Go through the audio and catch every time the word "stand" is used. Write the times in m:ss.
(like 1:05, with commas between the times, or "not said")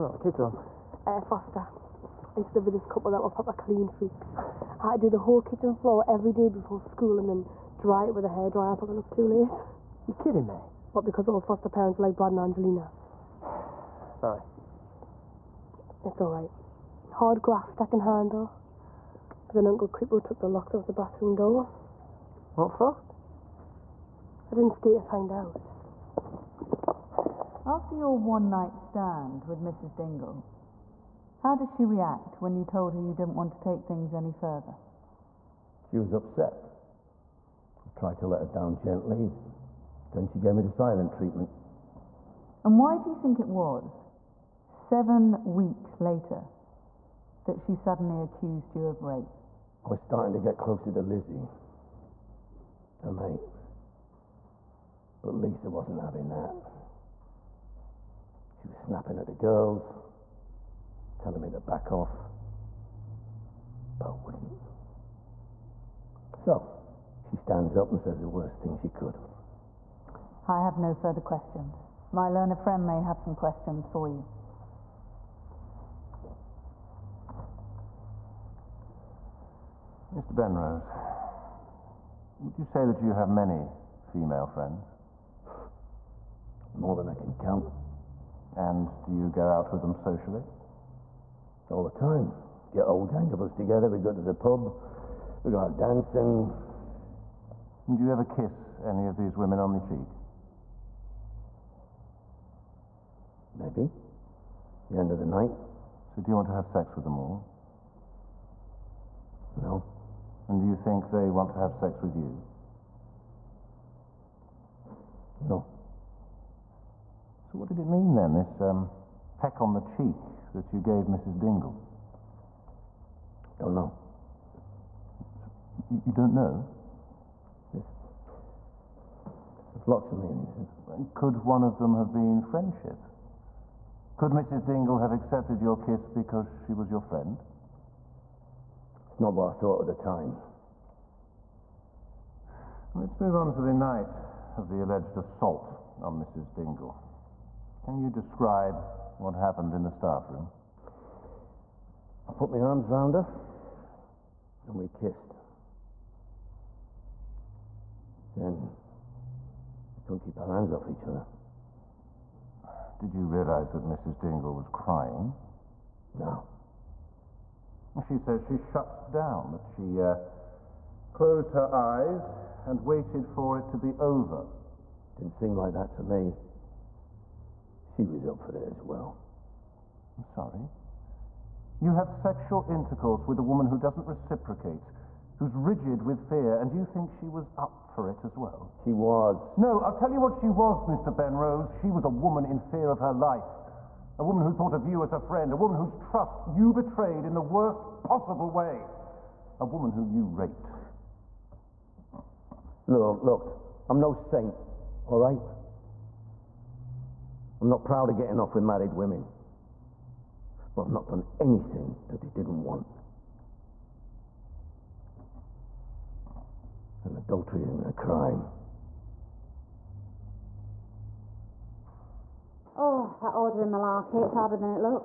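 0:28, 1:07.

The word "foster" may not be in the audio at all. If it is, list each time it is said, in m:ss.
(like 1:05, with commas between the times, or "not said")
0:01, 0:11.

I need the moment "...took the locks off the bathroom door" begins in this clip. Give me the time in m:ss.
0:20.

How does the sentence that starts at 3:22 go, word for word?
Look, look, I'm no saint, all right?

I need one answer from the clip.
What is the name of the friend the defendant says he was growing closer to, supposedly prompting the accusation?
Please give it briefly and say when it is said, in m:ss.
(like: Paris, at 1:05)
Lizzie, at 0:51.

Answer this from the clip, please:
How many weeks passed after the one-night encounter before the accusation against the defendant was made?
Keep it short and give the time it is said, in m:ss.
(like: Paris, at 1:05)
7, at 0:44.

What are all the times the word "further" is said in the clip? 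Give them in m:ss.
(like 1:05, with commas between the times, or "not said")
0:34, 1:10.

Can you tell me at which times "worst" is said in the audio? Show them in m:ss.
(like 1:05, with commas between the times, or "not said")
1:08, 3:17.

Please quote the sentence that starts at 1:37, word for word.
Do you ever kiss any of these women on the cheek?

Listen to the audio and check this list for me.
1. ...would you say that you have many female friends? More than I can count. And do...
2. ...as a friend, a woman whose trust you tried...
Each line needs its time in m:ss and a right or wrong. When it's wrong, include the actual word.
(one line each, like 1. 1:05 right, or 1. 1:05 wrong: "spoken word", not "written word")
1. 1:22 right
2. 3:15 wrong: "betrayed", not "tried".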